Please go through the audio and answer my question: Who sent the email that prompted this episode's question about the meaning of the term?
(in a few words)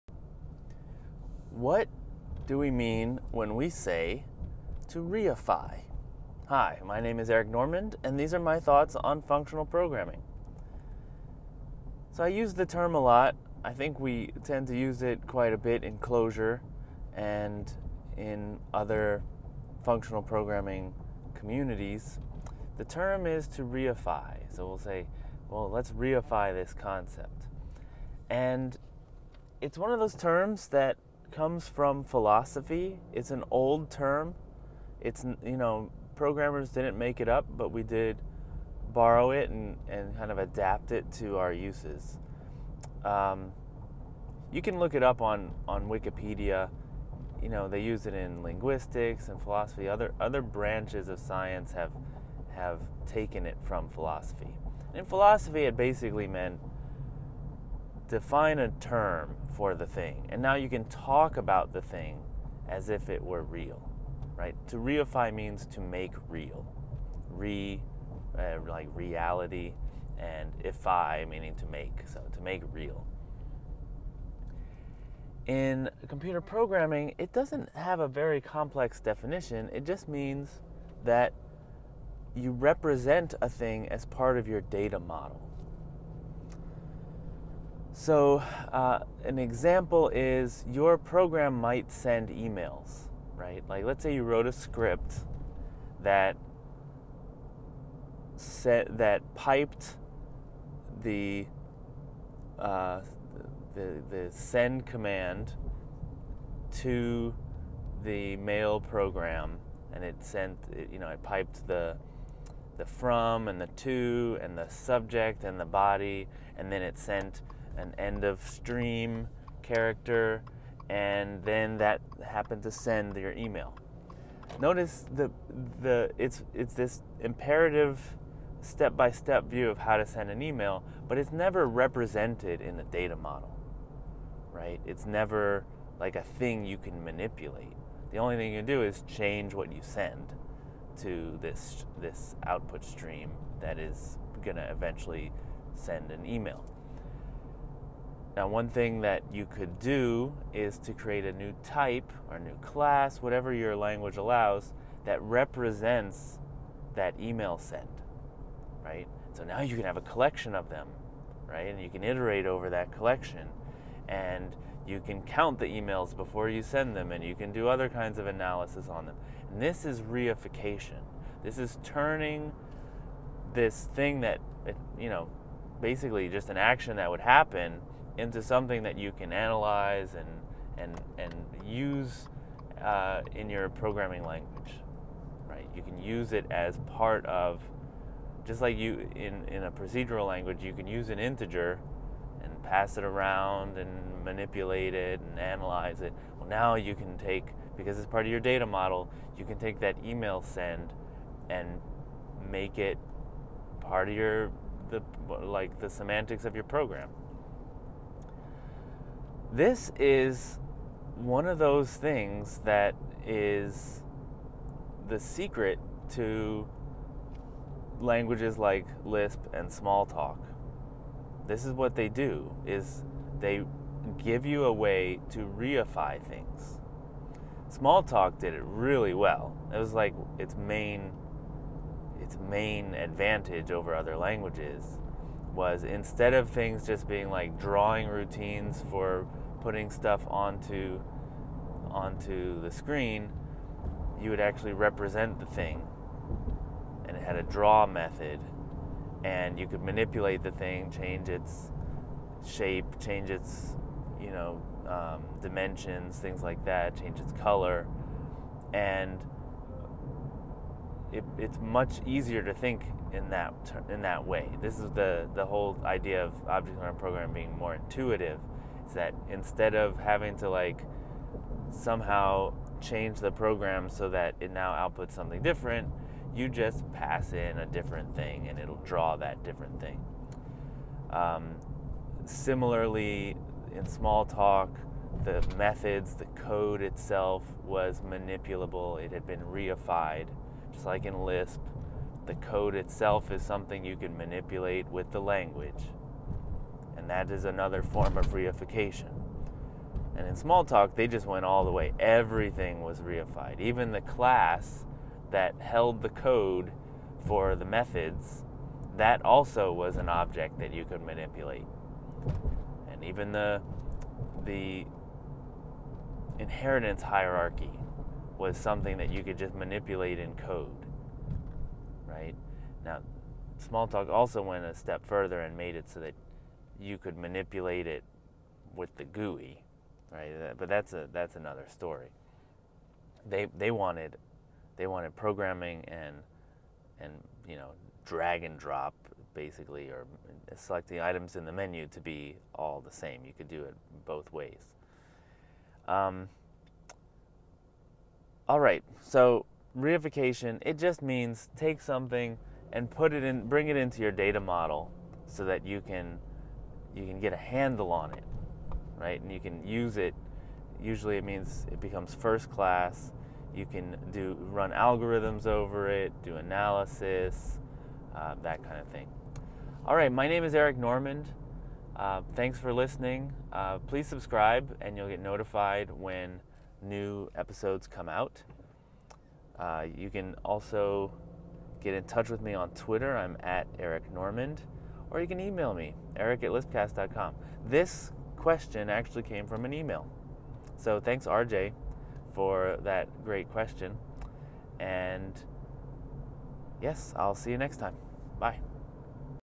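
RJ.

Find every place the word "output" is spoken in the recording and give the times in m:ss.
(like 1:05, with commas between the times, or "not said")
2:22, 4:34.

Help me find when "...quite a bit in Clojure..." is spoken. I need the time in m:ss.
0:15.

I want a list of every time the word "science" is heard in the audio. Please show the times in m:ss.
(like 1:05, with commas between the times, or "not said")
0:51.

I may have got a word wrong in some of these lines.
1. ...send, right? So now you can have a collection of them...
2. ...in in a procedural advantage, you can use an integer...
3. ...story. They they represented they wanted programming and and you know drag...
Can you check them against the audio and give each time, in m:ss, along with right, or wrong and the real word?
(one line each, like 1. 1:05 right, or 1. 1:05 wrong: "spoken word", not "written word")
1. 2:37 right
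2. 3:09 wrong: "language", not "advantage"
3. 5:31 wrong: "wanted", not "represented".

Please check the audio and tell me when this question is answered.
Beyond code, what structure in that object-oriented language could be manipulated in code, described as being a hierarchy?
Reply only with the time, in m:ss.
5:16.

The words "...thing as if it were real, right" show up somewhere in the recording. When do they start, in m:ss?
1:01.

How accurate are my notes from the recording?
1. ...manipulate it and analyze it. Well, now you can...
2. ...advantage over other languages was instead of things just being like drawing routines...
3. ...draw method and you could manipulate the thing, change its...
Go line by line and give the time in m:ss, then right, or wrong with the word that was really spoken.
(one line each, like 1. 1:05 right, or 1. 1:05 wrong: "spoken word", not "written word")
1. 3:14 right
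2. 3:52 right
3. 4:07 right.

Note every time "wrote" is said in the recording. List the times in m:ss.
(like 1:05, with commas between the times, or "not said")
1:34.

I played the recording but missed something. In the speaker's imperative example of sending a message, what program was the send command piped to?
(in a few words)
The mail program.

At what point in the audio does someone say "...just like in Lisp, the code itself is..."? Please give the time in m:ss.
4:50.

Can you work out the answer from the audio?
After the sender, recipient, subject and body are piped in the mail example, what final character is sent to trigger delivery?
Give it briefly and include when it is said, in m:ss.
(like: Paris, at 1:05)
End of stream character, at 1:57.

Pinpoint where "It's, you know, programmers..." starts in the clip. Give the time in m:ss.
0:34.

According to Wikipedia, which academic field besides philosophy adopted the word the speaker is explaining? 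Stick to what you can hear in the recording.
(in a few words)
Linguistics.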